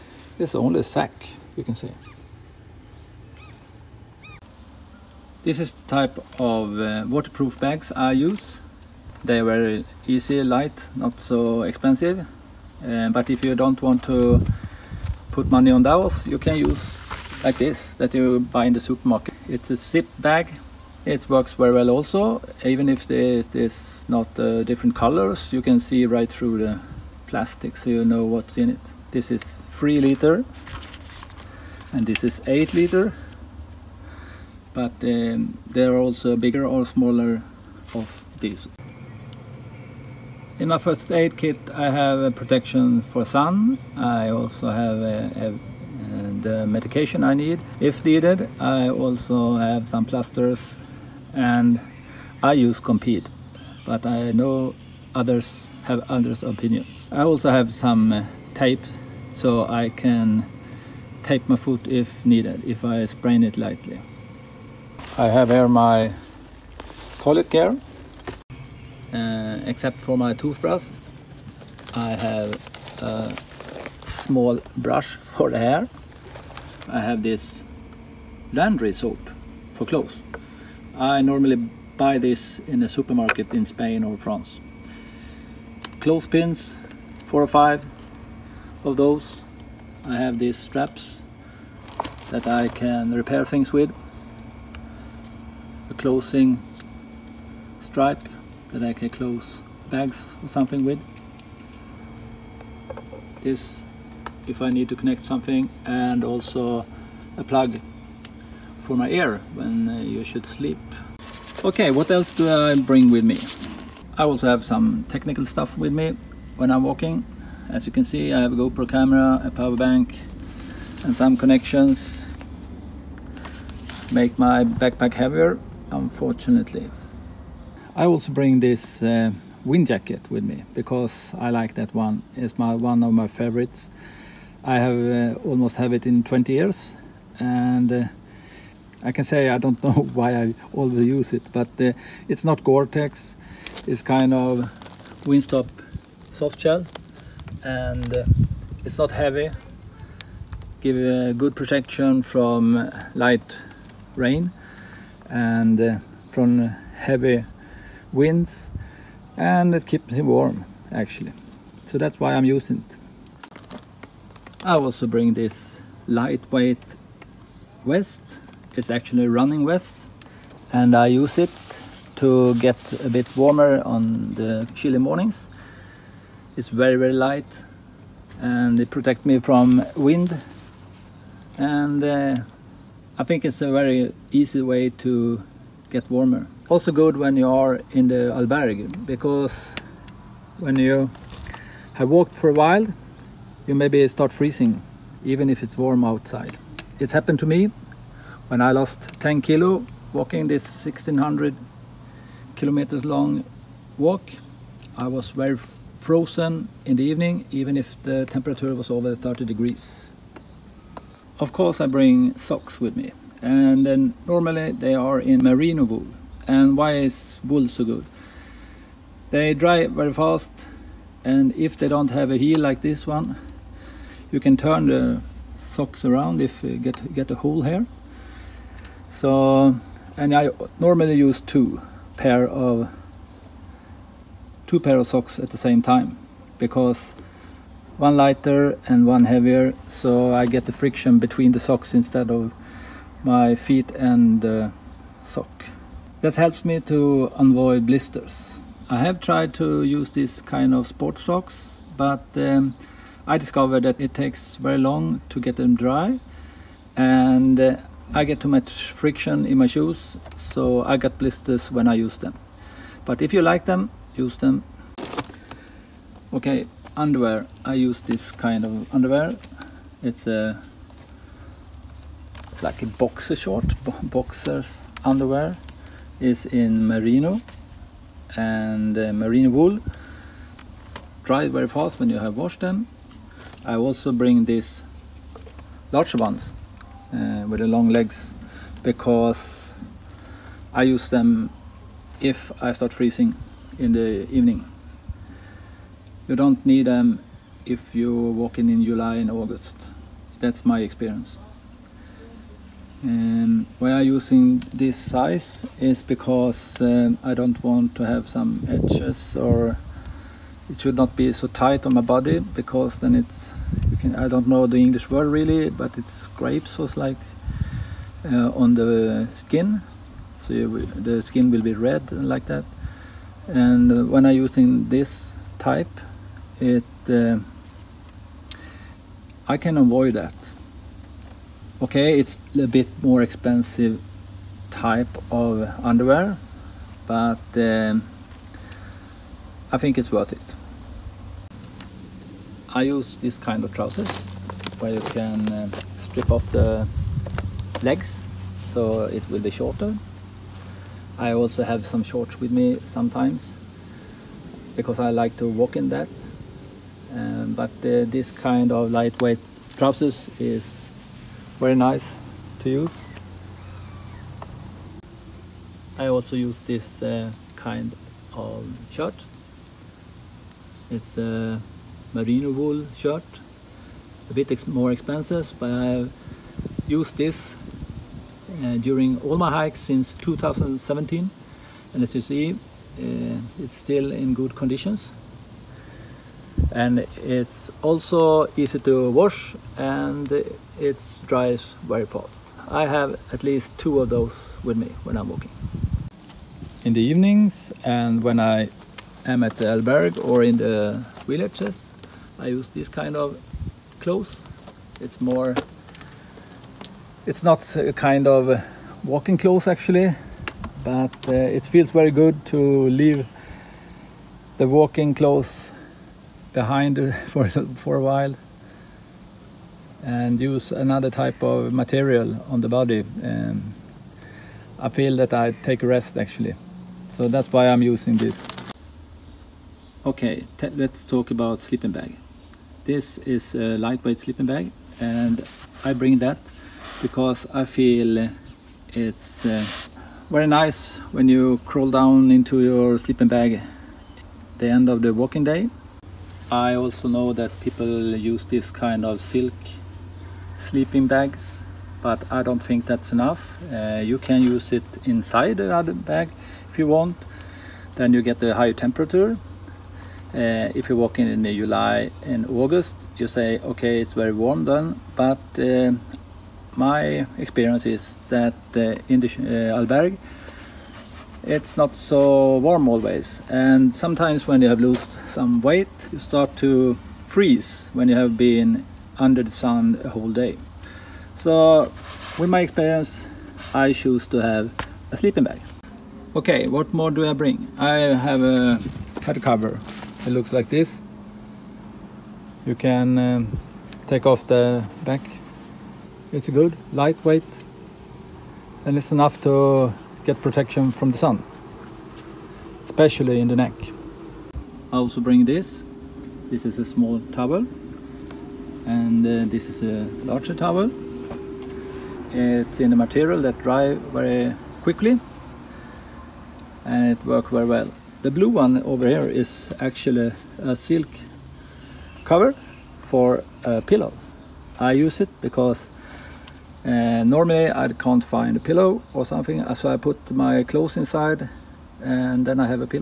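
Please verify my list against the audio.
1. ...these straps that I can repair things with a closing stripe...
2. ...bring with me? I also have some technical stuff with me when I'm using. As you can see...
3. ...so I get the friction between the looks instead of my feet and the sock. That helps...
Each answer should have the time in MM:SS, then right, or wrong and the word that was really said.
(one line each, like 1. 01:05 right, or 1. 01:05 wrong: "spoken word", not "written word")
1. 01:30 right
2. 01:52 wrong: "walking", not "using"
3. 03:59 wrong: "socks", not "looks".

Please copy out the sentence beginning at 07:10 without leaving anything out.
Okay, let's talk about sleeping bag.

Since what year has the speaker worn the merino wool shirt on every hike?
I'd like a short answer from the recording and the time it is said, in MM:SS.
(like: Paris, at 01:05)
2017, at 06:20.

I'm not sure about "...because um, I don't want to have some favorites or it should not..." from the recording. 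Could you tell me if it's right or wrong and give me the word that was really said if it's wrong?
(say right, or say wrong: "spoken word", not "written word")
wrong: "edges", not "favorites".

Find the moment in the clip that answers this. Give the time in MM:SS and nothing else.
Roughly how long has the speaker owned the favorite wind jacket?
02:16.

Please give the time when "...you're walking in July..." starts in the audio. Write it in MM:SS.
04:57.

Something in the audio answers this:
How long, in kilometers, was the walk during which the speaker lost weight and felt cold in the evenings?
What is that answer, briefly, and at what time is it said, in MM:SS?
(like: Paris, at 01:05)
1600 kilometers, at 03:20.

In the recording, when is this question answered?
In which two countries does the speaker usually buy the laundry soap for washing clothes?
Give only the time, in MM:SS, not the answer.
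01:23.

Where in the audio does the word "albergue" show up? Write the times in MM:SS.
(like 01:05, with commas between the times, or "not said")
03:08, 06:39, 07:49.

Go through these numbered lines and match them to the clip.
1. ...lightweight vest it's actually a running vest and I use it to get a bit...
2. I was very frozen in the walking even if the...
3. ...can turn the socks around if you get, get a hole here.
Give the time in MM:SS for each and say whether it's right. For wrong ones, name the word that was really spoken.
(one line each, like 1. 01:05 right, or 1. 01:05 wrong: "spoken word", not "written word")
1. 02:46 right
2. 03:24 wrong: "evening", not "walking"
3. 03:44 right.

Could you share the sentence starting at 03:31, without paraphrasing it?
Of course I bring socks with me and then normally they are in merino wool.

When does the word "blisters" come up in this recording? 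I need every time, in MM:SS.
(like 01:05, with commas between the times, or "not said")
04:07, 04:21.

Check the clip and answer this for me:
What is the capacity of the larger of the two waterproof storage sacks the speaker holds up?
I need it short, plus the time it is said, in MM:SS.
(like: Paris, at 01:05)
8 liters, at 00:32.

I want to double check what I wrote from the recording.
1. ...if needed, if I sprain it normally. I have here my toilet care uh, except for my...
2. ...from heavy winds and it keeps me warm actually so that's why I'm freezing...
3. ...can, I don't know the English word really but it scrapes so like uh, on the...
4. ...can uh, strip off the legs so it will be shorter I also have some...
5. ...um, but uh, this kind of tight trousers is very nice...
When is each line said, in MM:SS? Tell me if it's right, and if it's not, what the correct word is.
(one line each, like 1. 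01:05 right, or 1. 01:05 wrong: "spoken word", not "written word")
1. 01:01 wrong: "lightly", not "normally"
2. 02:36 wrong: "using", not "freezing"
3. 05:14 right
4. 05:45 right
5. 05:57 wrong: "lightweight", not "tight".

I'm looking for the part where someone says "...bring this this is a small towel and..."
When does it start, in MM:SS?
08:25.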